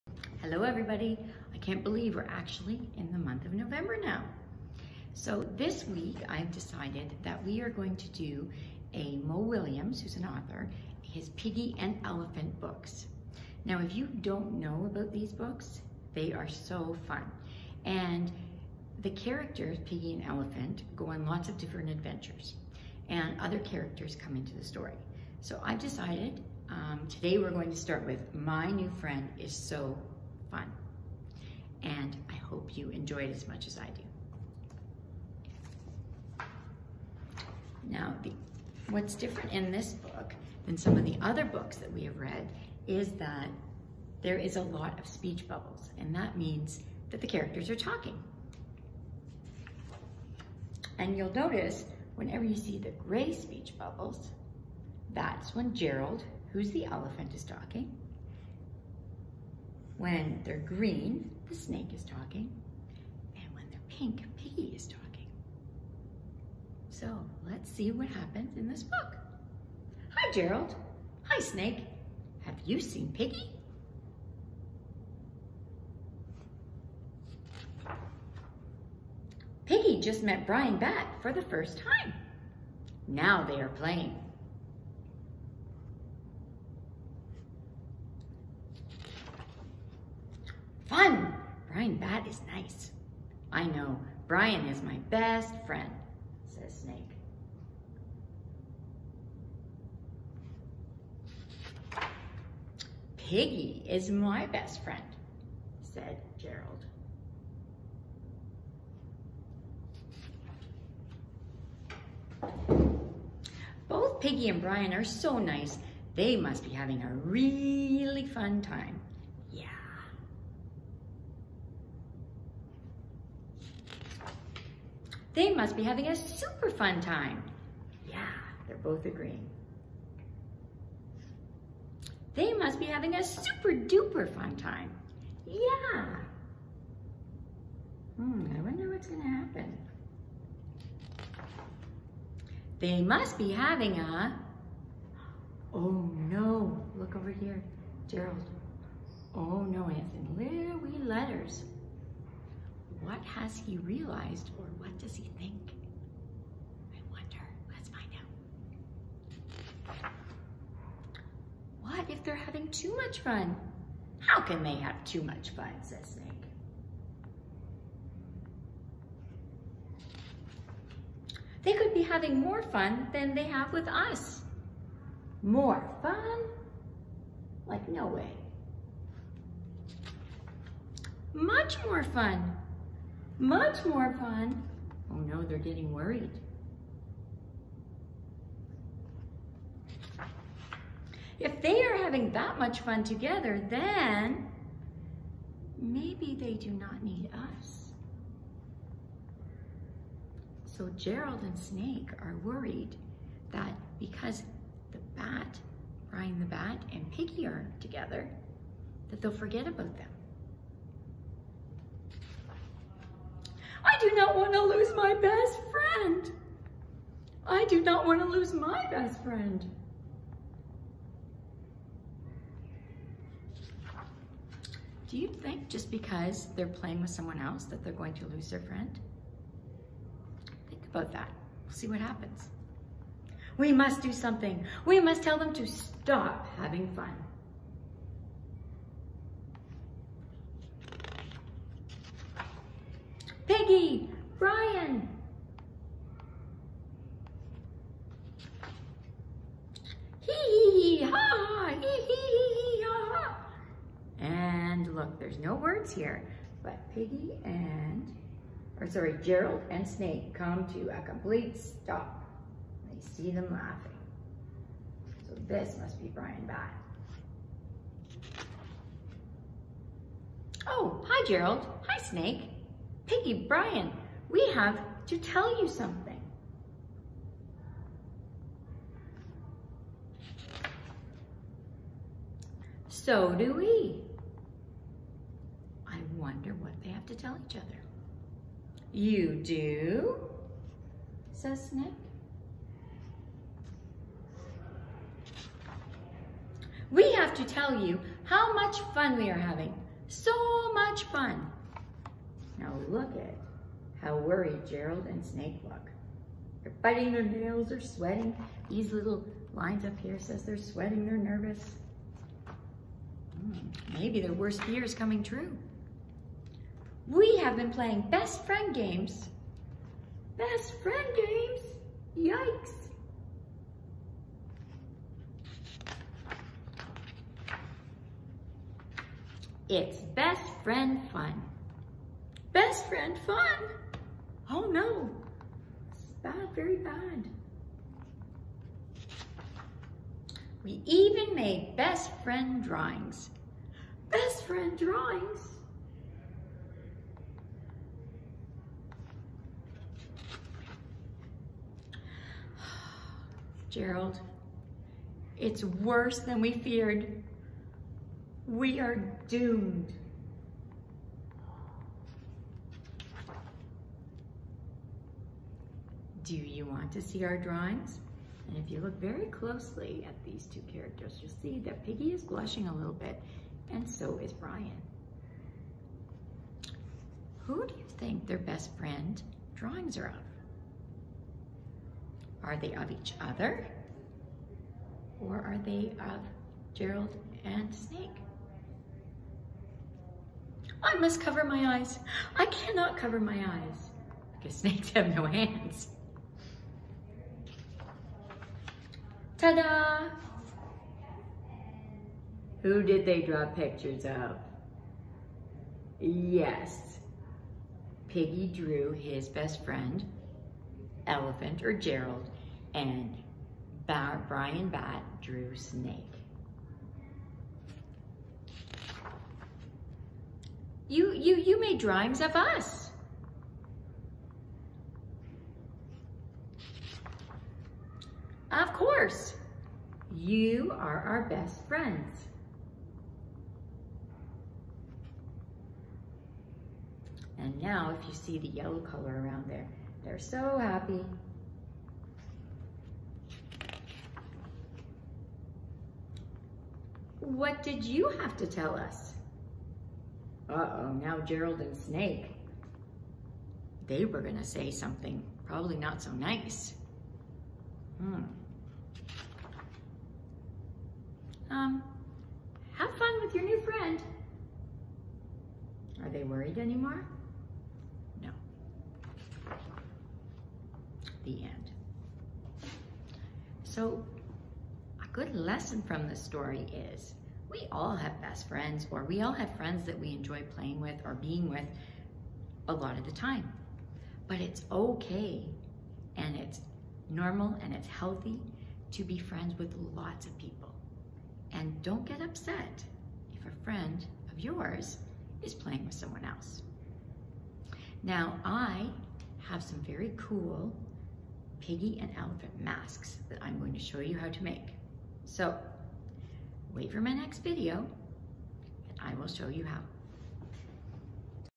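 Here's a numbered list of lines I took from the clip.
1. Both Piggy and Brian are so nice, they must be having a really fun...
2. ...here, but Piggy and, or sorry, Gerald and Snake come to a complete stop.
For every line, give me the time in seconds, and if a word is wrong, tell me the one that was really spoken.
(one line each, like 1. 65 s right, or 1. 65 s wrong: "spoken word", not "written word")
1. 113 s right
2. 255 s right.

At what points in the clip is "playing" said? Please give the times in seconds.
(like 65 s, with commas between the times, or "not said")
83 s, 226 s, 317 s, 480 s, 495 s.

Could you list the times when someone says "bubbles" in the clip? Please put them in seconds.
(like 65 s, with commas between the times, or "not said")
45 s, 53 s.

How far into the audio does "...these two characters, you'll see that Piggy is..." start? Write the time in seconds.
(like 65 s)
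370 s.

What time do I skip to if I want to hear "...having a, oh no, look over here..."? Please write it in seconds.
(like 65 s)
143 s.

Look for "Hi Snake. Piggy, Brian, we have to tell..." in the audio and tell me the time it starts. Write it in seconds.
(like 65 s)
271 s.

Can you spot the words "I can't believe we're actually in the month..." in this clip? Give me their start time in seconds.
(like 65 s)
1 s.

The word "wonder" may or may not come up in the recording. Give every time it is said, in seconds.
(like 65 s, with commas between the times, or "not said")
138 s, 157 s, 286 s.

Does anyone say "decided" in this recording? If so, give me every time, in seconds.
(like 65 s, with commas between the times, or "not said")
6 s, 25 s.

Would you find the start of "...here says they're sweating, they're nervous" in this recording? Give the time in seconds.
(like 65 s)
309 s.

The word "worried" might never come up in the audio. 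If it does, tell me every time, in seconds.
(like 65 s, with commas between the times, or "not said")
185 s, 202 s, 304 s, 466 s.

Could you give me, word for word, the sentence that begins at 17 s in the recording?
And the characters, Piggy and Elephant, go on lots of different adventures and other characters come into the story.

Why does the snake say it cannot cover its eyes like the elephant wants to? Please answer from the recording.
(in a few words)
Snakes have no hands.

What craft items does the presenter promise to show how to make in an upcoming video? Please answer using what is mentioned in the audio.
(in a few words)
Piggy and elephant masks.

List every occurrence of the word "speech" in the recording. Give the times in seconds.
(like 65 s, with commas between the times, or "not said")
45 s, 53 s.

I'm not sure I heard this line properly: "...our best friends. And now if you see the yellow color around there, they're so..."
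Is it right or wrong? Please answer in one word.
right.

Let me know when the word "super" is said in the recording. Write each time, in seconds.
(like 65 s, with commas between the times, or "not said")
126 s, 133 s.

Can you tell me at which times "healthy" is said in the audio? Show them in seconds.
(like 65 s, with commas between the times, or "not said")
487 s.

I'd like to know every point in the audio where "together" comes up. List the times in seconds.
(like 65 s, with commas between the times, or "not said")
193 s, 207 s.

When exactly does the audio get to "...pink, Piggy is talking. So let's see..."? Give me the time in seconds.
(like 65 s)
63 s.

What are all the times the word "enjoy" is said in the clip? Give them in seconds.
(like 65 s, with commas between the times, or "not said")
32 s, 480 s.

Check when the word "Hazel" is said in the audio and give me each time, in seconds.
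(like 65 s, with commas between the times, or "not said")
not said.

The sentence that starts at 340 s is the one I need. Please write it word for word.
We even made best friend drawings.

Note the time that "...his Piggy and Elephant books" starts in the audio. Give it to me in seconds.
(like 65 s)
11 s.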